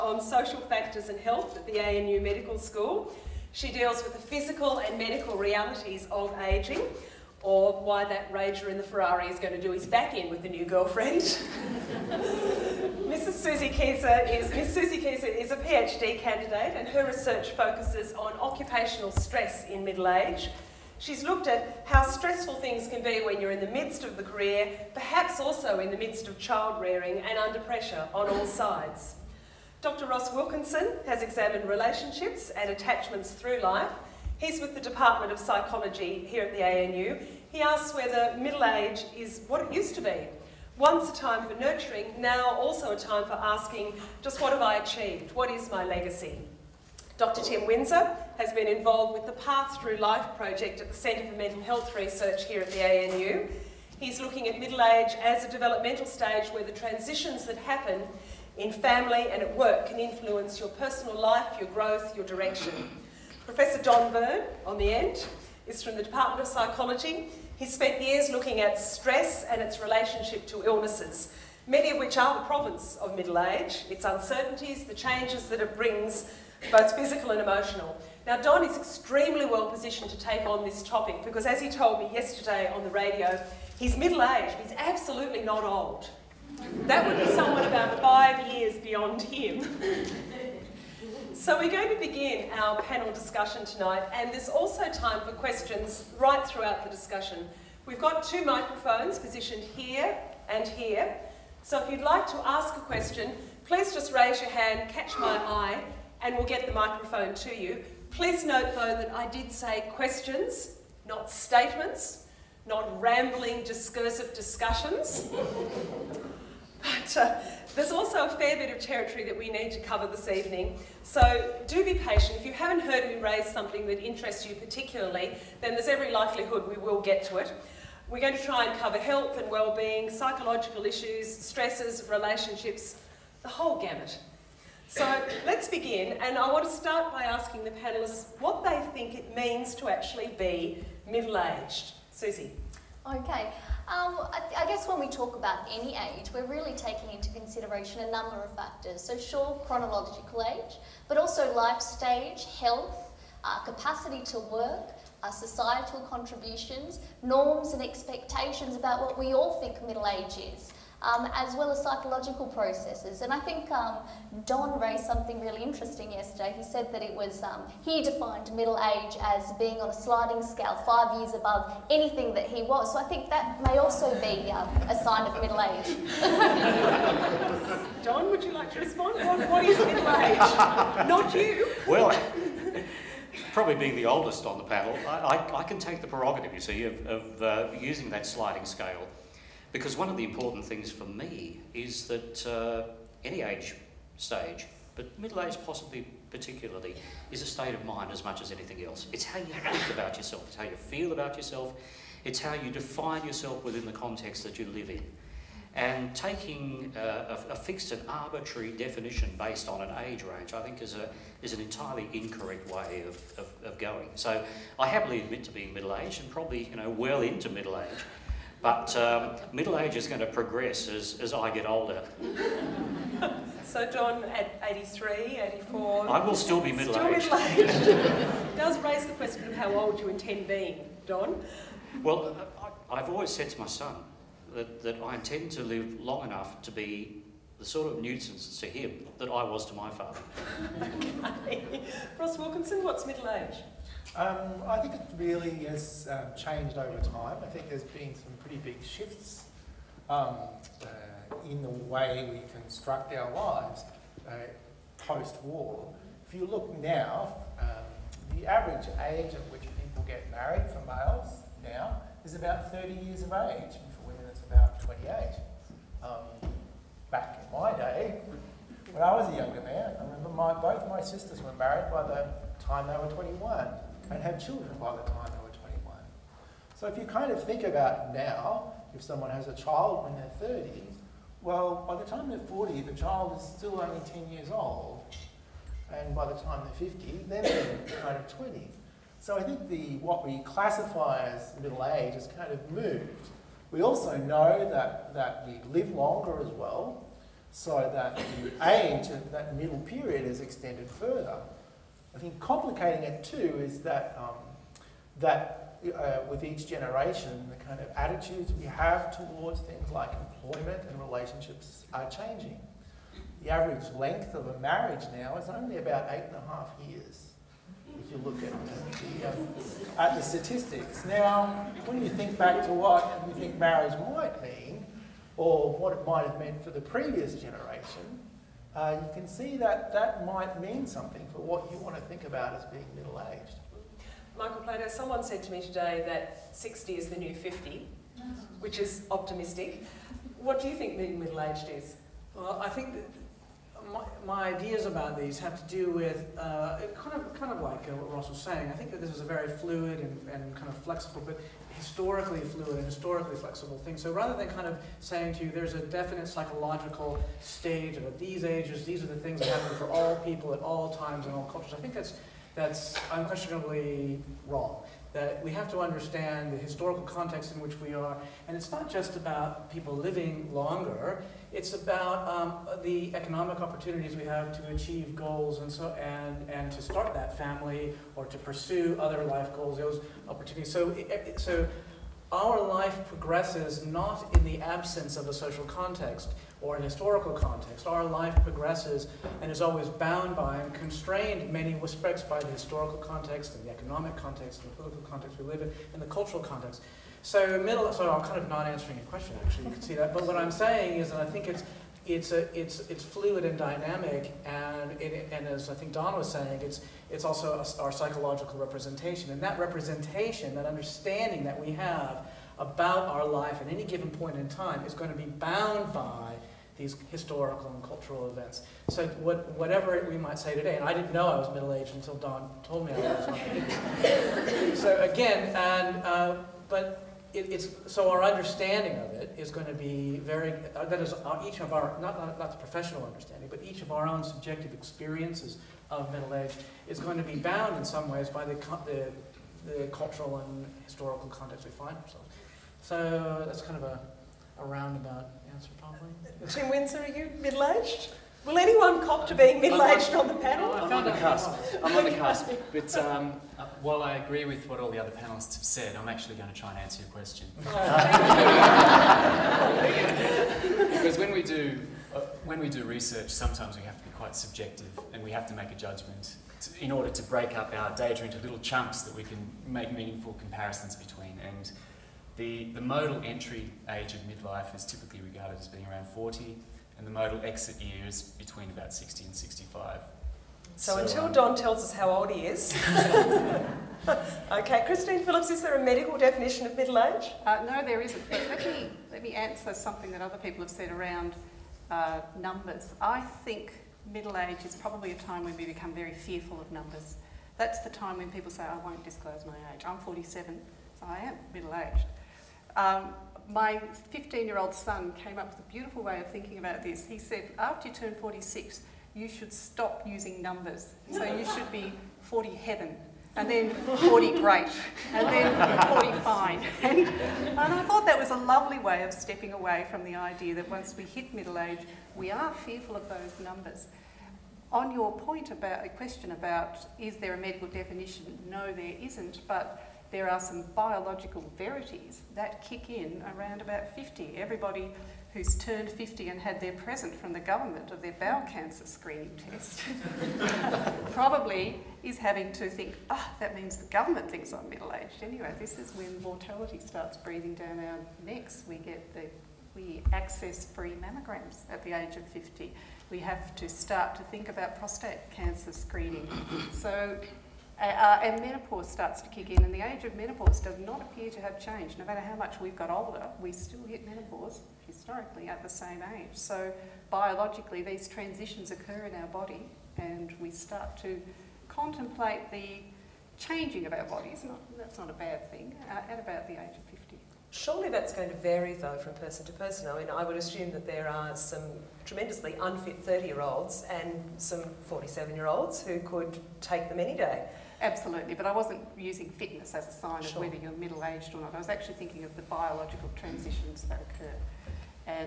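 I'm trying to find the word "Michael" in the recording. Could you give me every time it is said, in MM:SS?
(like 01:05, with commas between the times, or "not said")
05:34.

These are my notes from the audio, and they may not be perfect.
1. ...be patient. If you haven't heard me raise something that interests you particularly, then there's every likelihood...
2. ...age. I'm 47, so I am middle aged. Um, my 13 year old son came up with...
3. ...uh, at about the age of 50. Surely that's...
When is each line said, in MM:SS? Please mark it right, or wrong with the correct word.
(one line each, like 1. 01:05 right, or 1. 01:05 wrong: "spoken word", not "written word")
1. 02:01 right
2. 08:19 wrong: "15", not "13"
3. 09:35 right.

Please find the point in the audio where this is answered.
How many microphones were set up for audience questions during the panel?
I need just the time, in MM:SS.
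01:38.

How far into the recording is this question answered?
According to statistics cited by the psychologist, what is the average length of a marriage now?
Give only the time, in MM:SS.
05:16.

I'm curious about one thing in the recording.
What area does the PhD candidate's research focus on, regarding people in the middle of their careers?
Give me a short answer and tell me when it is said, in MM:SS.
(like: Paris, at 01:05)
Occupational stress, at 00:18.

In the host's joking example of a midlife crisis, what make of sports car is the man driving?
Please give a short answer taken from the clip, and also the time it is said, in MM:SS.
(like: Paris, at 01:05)
Ferrari, at 00:08.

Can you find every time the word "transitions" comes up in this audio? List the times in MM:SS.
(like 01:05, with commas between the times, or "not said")
00:56, 09:28, 09:53.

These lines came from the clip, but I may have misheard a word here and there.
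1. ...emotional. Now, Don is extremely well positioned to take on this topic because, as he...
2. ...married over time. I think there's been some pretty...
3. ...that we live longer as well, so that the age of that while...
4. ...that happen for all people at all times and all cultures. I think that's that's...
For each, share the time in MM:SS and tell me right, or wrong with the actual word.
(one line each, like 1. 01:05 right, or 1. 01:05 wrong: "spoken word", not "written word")
1. 01:17 right
2. 04:06 wrong: "changed", not "married"
3. 04:55 wrong: "middle", not "while"
4. 05:59 right.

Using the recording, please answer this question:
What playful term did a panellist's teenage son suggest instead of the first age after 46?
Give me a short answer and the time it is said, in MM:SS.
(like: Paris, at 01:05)
40 heaven, at 08:32.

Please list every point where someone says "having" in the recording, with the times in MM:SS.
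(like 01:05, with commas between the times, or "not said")
09:02.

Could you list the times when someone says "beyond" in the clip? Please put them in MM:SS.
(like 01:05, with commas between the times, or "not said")
01:28.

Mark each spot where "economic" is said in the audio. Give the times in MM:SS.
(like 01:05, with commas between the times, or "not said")
06:13, 06:33.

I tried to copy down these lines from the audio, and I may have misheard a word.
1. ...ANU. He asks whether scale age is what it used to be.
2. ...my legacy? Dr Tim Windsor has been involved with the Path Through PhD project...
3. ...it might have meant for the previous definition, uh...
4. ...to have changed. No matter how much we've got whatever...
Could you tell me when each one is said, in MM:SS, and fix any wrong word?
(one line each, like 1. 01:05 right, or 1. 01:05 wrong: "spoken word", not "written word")
1. 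00:36 wrong: "middle", not "scale"
2. 00:45 wrong: "Life", not "PhD"
3. 05:25 wrong: "generation", not "definition"
4. 09:21 wrong: "older", not "whatever".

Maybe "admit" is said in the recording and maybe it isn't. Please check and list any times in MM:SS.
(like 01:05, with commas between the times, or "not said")
03:35.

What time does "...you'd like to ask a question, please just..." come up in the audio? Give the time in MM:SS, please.
01:41.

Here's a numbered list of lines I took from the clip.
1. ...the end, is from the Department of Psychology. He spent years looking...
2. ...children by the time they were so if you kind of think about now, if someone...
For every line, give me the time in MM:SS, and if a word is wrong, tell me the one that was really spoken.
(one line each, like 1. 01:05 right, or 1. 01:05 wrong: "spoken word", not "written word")
1. 01:04 right
2. 04:34 right.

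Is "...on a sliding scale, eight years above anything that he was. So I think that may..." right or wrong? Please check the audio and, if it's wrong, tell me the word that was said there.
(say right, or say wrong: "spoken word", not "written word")
wrong: "five", not "eight".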